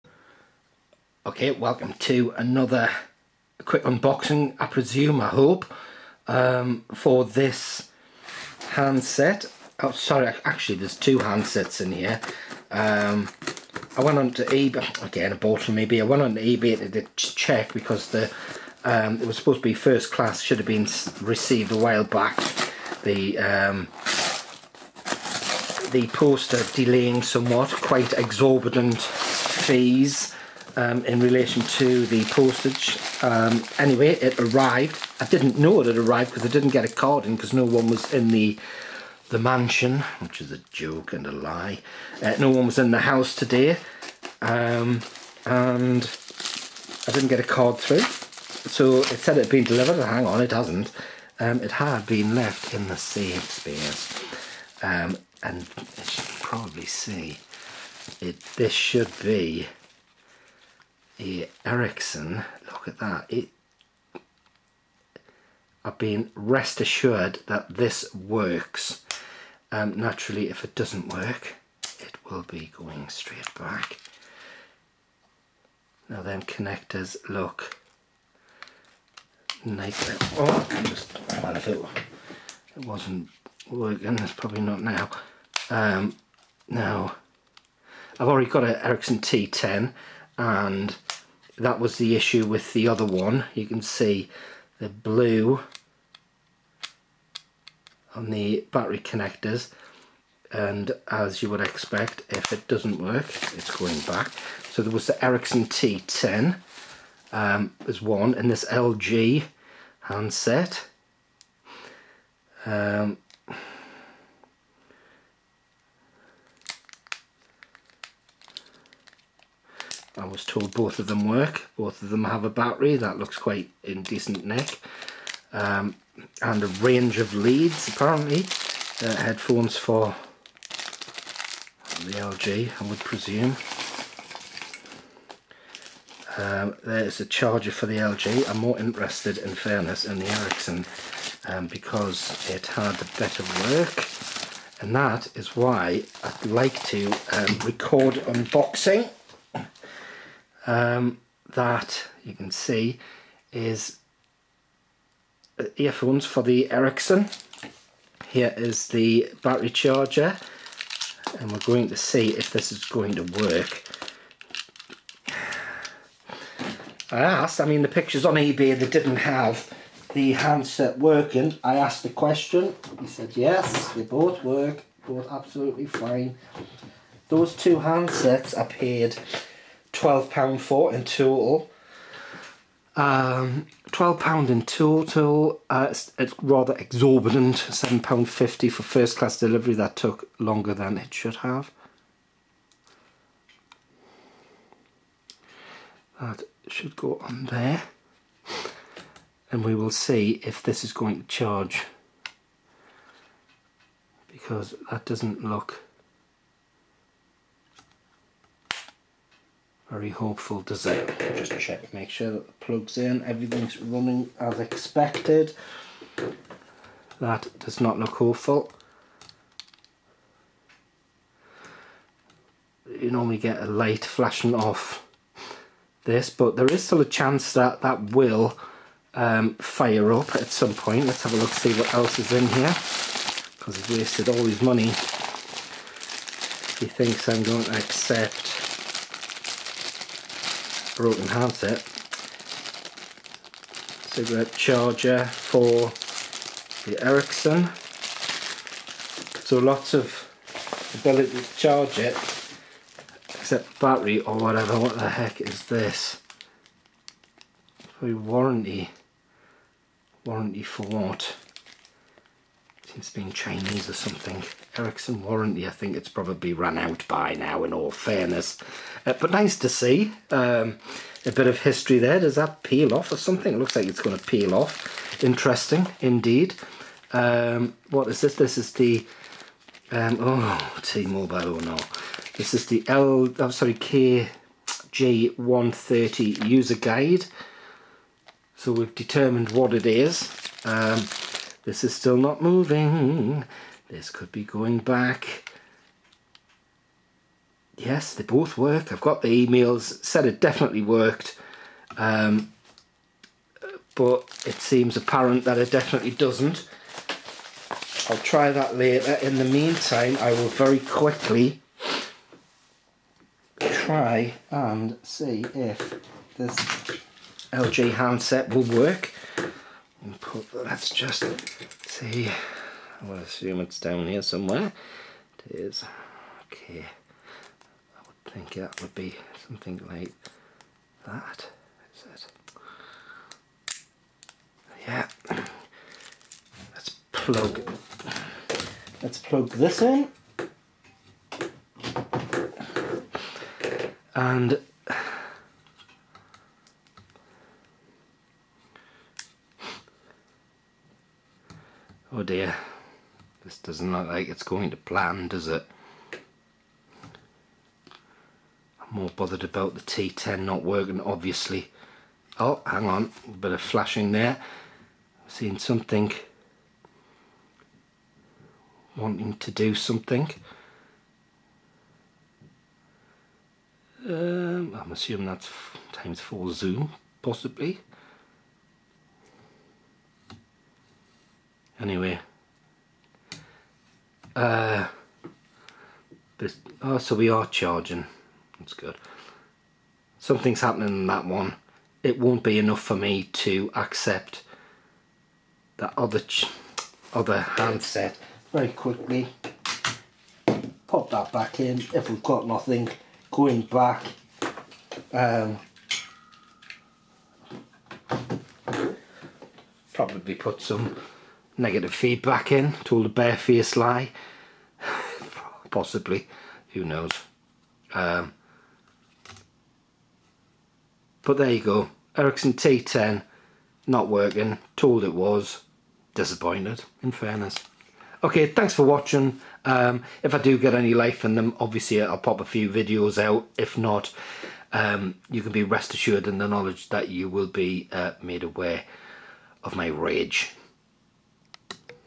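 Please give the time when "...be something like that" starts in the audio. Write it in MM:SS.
05:28.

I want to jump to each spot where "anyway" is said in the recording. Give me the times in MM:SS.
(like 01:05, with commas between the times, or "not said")
00:33, 06:21.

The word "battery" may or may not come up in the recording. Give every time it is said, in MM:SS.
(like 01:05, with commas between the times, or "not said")
01:38, 02:02, 02:39, 04:13.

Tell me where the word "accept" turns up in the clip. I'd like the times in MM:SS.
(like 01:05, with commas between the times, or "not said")
03:57, 06:33.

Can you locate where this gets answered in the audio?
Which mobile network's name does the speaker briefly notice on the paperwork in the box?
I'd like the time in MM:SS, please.
04:40.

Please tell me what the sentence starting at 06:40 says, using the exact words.
Pop that back in if we've got nothing.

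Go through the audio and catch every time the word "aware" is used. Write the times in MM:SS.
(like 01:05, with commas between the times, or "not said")
07:18.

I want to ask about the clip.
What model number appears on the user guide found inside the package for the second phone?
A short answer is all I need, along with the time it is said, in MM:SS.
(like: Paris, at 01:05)
KG130, at 04:43.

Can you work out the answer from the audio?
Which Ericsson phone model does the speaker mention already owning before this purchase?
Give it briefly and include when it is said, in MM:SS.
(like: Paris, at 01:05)
T10, at 01:28.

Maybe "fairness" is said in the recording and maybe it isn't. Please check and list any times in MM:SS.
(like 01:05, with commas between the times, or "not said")
02:19, 04:27, 07:07.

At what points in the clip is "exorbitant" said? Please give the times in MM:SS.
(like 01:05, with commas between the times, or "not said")
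00:28, 03:06.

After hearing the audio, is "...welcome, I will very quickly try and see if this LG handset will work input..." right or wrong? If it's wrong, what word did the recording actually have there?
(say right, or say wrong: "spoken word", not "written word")
wrong: "meantime", not "welcome".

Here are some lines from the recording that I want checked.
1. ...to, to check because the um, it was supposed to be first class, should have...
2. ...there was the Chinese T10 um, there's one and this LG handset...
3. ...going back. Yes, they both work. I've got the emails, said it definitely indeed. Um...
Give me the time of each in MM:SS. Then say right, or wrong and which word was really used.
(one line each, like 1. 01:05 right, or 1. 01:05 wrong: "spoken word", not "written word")
1. 00:16 right
2. 01:44 wrong: "Ericsson", not "Chinese"
3. 04:54 wrong: "worked", not "indeed".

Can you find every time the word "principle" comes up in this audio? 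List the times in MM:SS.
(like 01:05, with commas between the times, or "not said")
not said.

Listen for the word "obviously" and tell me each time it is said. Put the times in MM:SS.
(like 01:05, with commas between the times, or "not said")
06:00, 07:11.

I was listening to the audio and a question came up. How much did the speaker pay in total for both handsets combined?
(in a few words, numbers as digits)
£12.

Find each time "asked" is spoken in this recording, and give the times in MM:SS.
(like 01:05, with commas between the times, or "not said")
02:47, 02:51.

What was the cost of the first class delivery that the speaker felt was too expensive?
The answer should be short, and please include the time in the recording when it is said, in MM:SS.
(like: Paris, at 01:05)
£7.50, at 03:07.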